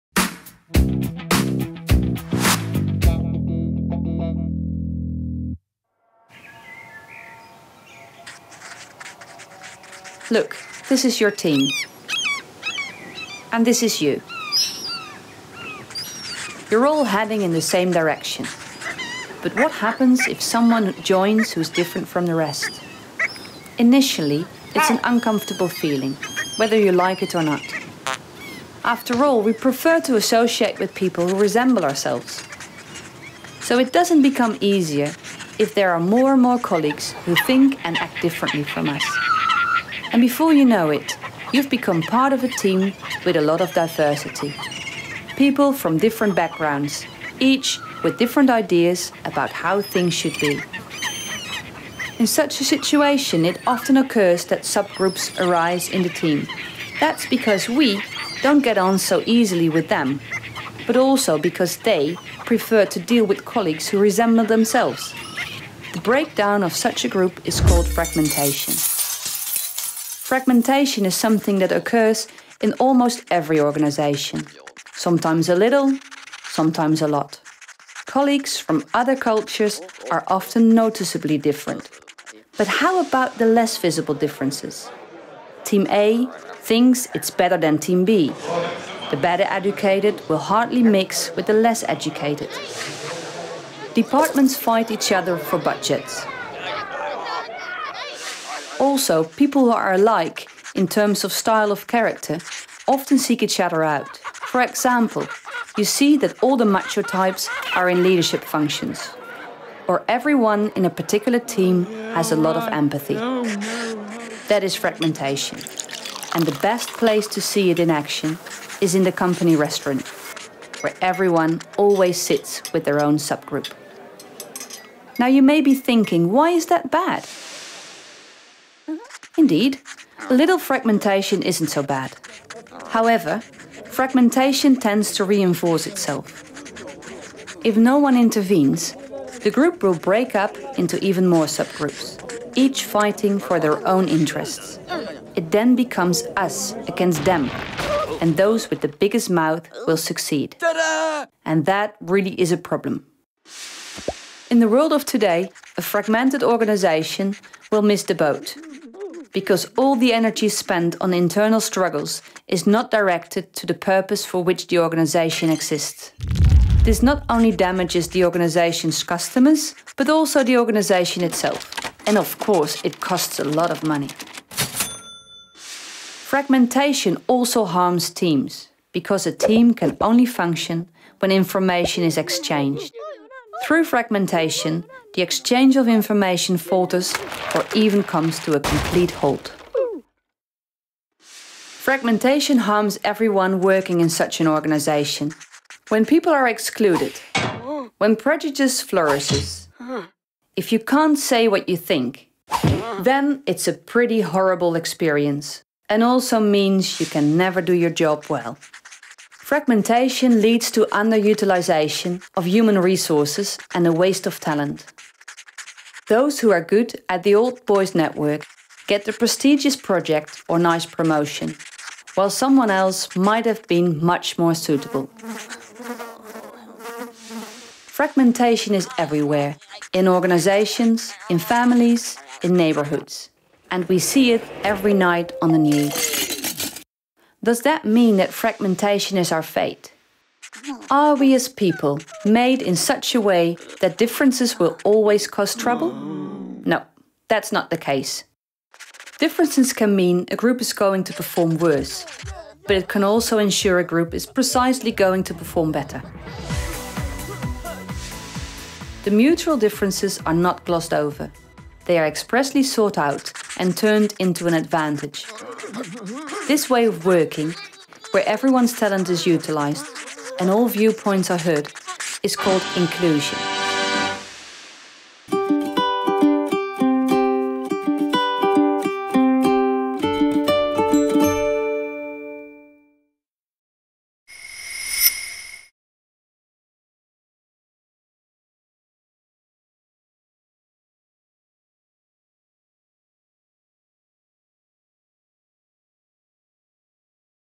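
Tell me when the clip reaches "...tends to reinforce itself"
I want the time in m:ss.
2:14.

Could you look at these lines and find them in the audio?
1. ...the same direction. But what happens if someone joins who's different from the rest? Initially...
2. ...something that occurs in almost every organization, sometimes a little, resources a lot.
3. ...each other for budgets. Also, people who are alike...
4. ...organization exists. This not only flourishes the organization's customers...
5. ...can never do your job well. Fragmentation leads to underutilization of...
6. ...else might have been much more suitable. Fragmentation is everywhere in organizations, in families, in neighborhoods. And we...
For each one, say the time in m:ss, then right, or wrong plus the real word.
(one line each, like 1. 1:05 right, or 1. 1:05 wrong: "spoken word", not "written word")
1. 0:17 right
2. 1:11 wrong: "sometimes", not "resources"
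3. 1:34 right
4. 2:44 wrong: "damages", not "flourishes"
5. 3:27 right
6. 3:42 right.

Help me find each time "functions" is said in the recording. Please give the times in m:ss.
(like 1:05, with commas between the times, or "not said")
1:48, 3:00.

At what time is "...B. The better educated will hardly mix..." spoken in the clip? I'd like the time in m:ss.
1:28.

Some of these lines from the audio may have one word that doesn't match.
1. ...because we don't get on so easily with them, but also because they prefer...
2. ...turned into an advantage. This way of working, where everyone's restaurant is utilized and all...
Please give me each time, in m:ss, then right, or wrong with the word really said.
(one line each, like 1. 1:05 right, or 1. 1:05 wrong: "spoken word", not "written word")
1. 0:57 right
2. 4:23 wrong: "talent", not "restaurant".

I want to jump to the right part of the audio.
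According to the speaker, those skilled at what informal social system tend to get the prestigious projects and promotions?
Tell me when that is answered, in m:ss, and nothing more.
3:37.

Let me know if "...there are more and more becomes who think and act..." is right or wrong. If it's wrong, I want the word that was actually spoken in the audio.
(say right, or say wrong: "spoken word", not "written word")
wrong: "colleagues", not "becomes".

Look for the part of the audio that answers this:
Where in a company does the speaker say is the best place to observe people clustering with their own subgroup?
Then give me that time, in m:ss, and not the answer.
1:59.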